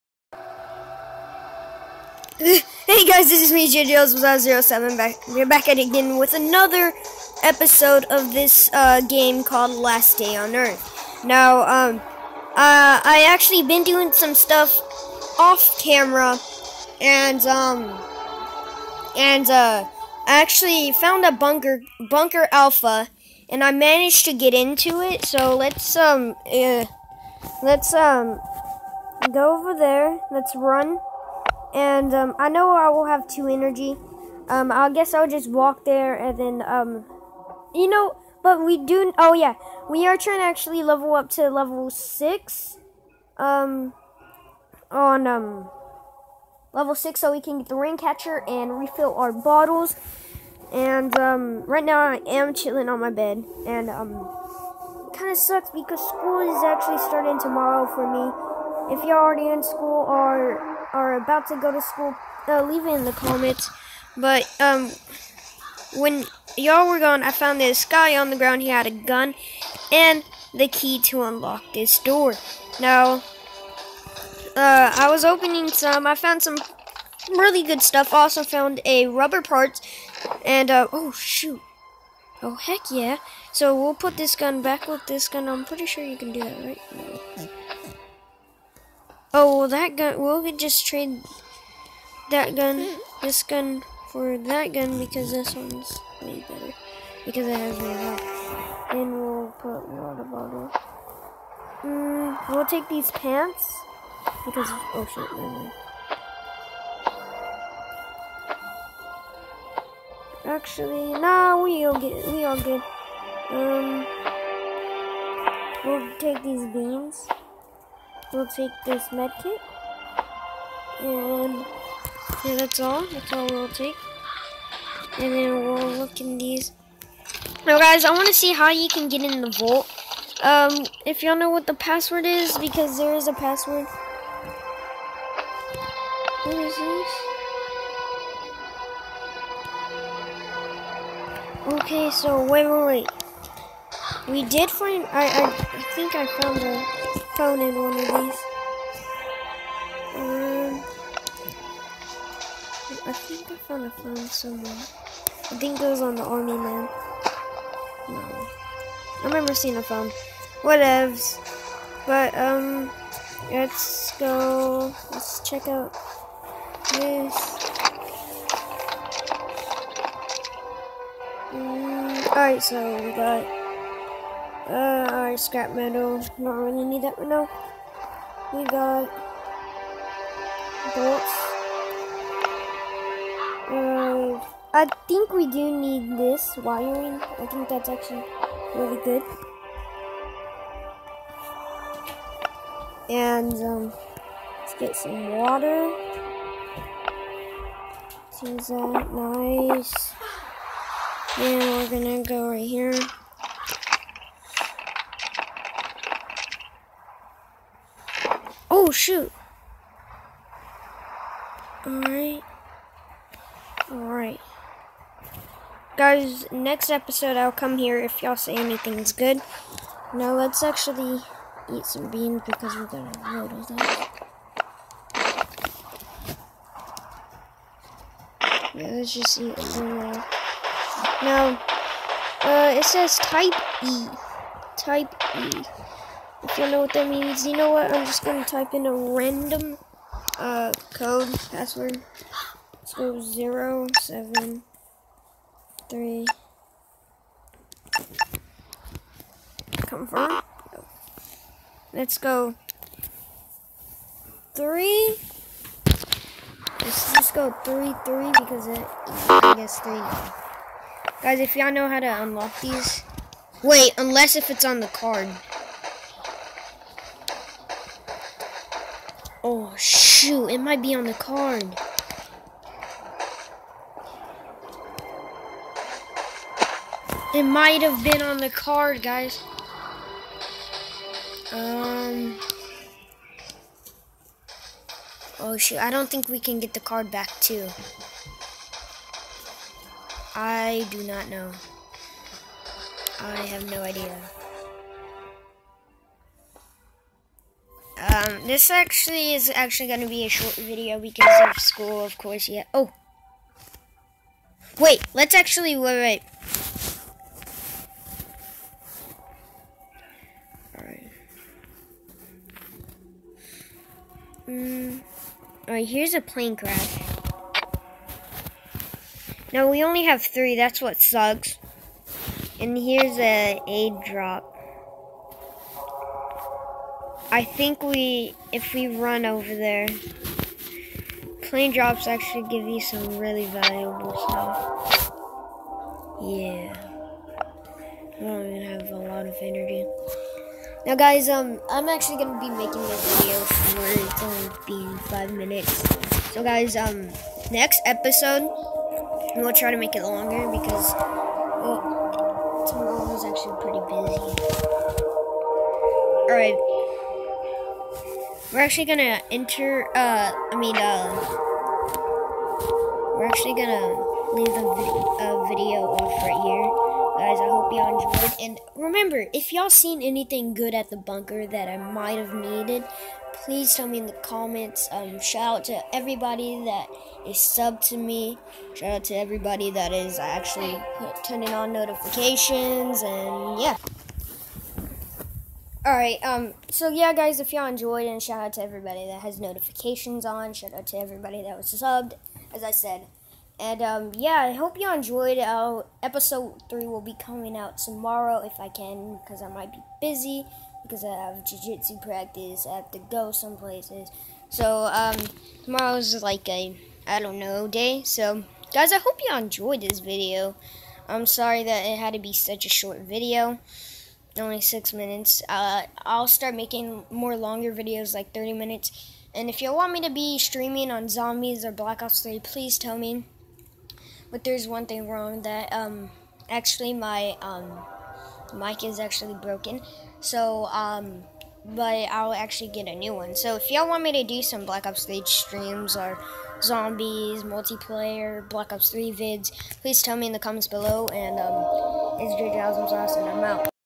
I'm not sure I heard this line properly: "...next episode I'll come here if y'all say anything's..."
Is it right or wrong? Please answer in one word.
right.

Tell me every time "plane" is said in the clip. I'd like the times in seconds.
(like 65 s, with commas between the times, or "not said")
316 s, 331 s.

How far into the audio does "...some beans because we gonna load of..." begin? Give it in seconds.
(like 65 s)
221 s.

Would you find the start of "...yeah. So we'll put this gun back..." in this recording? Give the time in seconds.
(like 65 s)
82 s.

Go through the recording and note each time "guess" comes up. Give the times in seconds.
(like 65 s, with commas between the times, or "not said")
34 s, 259 s.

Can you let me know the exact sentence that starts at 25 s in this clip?
So let's um, uh, let's um, go over there.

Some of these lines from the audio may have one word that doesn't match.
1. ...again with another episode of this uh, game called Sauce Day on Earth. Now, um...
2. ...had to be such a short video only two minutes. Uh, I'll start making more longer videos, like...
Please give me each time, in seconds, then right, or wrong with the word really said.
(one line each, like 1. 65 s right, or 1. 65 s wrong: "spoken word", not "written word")
1. 5 s wrong: "Last", not "Sauce"
2. 411 s wrong: "six", not "two".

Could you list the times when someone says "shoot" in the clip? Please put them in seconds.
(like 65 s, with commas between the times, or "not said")
81 s, 208 s, 269 s, 285 s.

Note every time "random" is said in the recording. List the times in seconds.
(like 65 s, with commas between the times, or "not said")
238 s.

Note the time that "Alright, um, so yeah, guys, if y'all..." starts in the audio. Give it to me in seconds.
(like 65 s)
385 s.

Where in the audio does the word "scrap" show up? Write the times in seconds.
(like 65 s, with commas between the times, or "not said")
175 s.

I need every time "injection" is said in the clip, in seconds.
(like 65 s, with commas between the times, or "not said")
not said.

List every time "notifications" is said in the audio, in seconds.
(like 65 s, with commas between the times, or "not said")
381 s, 389 s.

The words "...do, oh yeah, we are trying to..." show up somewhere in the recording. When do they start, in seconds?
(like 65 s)
38 s.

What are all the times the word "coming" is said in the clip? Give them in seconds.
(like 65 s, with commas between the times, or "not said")
397 s.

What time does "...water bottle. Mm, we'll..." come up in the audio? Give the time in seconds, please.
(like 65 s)
99 s.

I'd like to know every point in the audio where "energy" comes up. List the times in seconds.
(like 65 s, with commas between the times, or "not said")
33 s, 339 s.